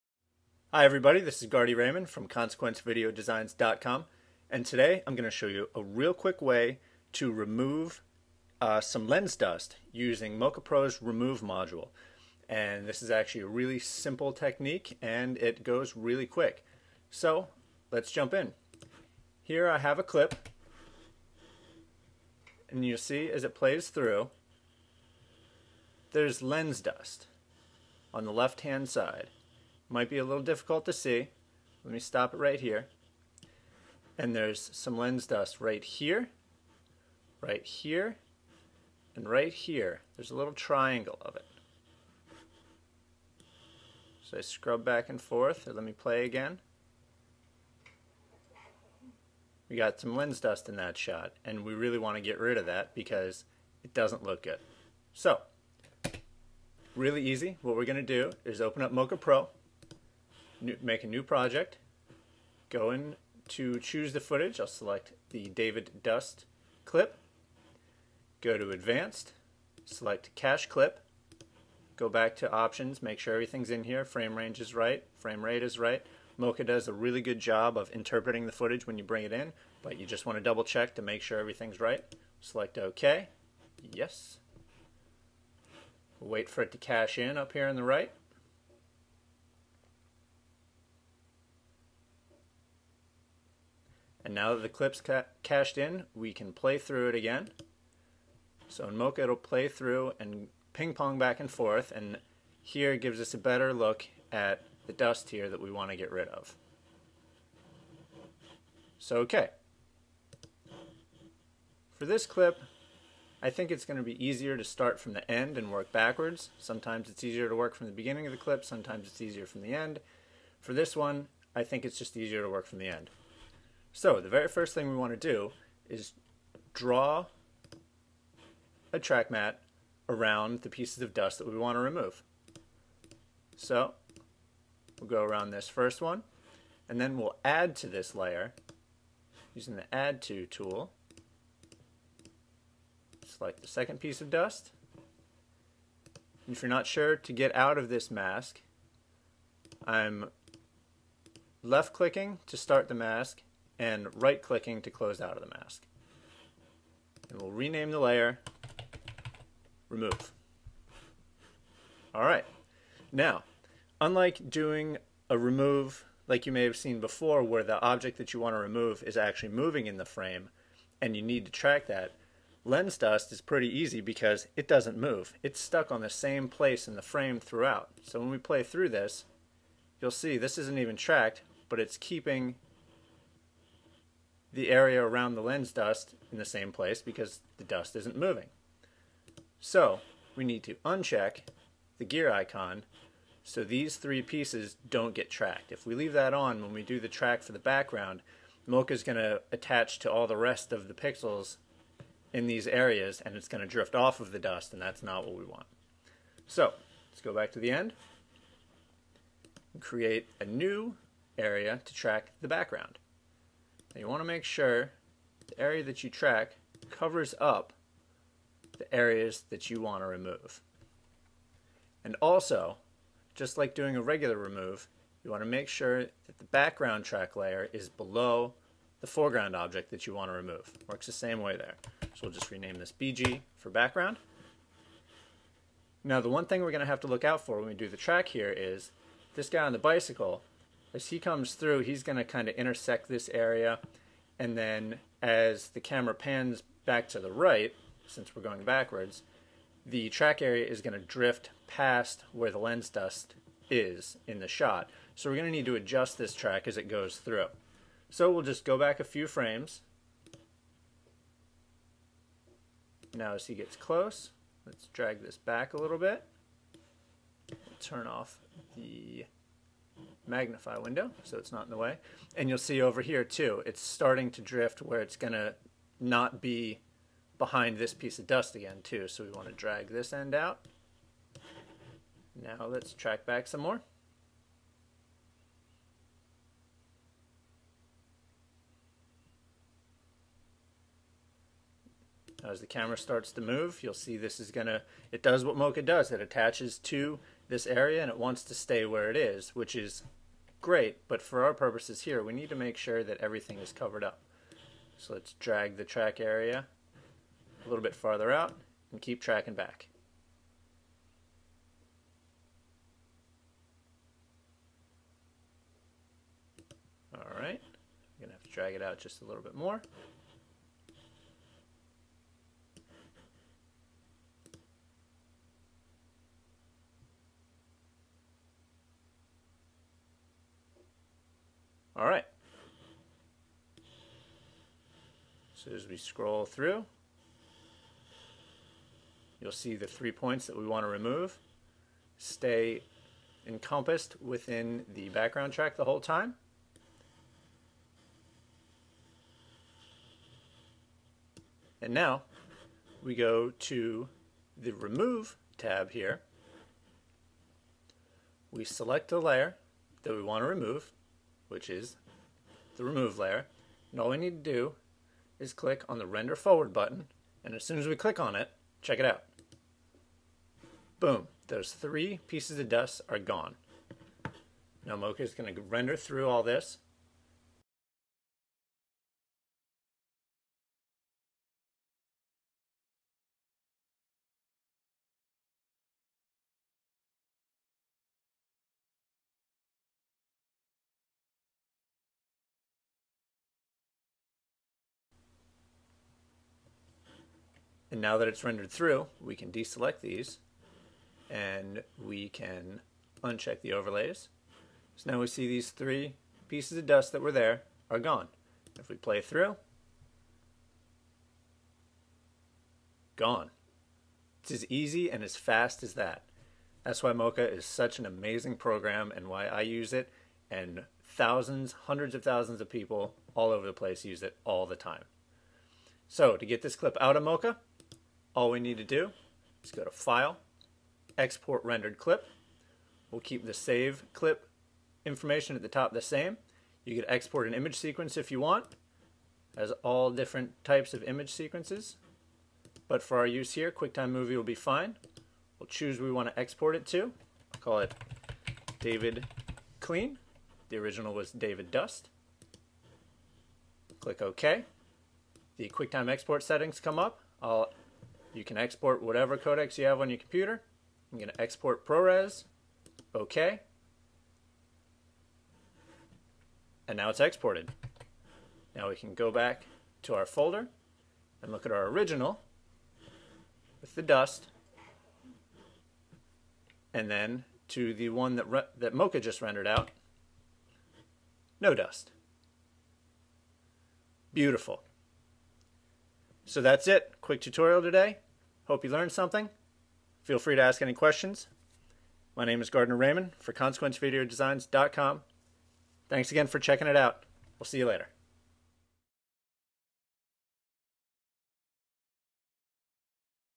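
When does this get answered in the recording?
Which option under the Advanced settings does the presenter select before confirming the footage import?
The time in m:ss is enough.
1:10.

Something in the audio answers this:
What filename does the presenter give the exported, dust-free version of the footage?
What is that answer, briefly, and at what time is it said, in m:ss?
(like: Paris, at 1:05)
David Clean, at 7:28.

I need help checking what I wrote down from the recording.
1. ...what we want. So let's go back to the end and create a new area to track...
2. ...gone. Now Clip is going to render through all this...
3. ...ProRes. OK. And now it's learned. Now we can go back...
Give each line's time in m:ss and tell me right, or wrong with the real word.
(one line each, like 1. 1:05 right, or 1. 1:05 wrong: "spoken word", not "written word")
1. 3:25 right
2. 6:13 wrong: "Mocha", not "Clip"
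3. 7:41 wrong: "exported", not "learned".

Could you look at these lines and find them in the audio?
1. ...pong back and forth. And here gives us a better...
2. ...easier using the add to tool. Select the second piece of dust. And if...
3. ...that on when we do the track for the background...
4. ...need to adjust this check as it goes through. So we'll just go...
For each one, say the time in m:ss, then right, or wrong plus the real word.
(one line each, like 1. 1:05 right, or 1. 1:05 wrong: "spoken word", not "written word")
1. 1:40 right
2. 2:18 wrong: "layer", not "easier"
3. 3:16 right
4. 4:15 wrong: "track", not "check".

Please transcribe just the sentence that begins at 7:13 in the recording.
We'll keep the Save Clip information at the top the same.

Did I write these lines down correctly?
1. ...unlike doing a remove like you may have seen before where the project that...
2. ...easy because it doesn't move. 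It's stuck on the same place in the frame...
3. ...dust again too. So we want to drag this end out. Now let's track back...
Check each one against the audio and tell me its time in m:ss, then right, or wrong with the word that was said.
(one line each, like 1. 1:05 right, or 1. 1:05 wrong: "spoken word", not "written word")
1. 2:43 wrong: "object", not "project"
2. 2:53 right
3. 4:38 right.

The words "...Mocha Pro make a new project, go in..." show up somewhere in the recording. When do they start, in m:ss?
0:58.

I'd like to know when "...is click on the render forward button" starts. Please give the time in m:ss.
6:05.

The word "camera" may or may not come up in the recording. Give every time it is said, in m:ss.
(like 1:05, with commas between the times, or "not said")
4:05, 4:52.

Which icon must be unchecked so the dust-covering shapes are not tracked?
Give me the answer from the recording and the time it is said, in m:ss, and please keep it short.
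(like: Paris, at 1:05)
gear icon, at 3:12.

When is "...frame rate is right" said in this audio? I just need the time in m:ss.
1:15.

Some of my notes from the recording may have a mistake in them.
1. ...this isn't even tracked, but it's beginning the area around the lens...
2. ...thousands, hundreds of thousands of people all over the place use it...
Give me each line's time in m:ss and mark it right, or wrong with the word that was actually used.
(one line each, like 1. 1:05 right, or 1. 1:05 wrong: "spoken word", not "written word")
1. 3:00 wrong: "keeping", not "beginning"
2. 7:01 right.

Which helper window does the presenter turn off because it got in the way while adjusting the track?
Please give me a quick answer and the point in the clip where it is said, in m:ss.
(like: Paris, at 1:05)
magnify window, at 4:30.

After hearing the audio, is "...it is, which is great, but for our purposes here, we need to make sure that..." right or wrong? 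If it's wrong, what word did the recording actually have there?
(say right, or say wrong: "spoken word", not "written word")
right.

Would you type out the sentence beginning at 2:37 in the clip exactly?
And we'll rename the layer, remove.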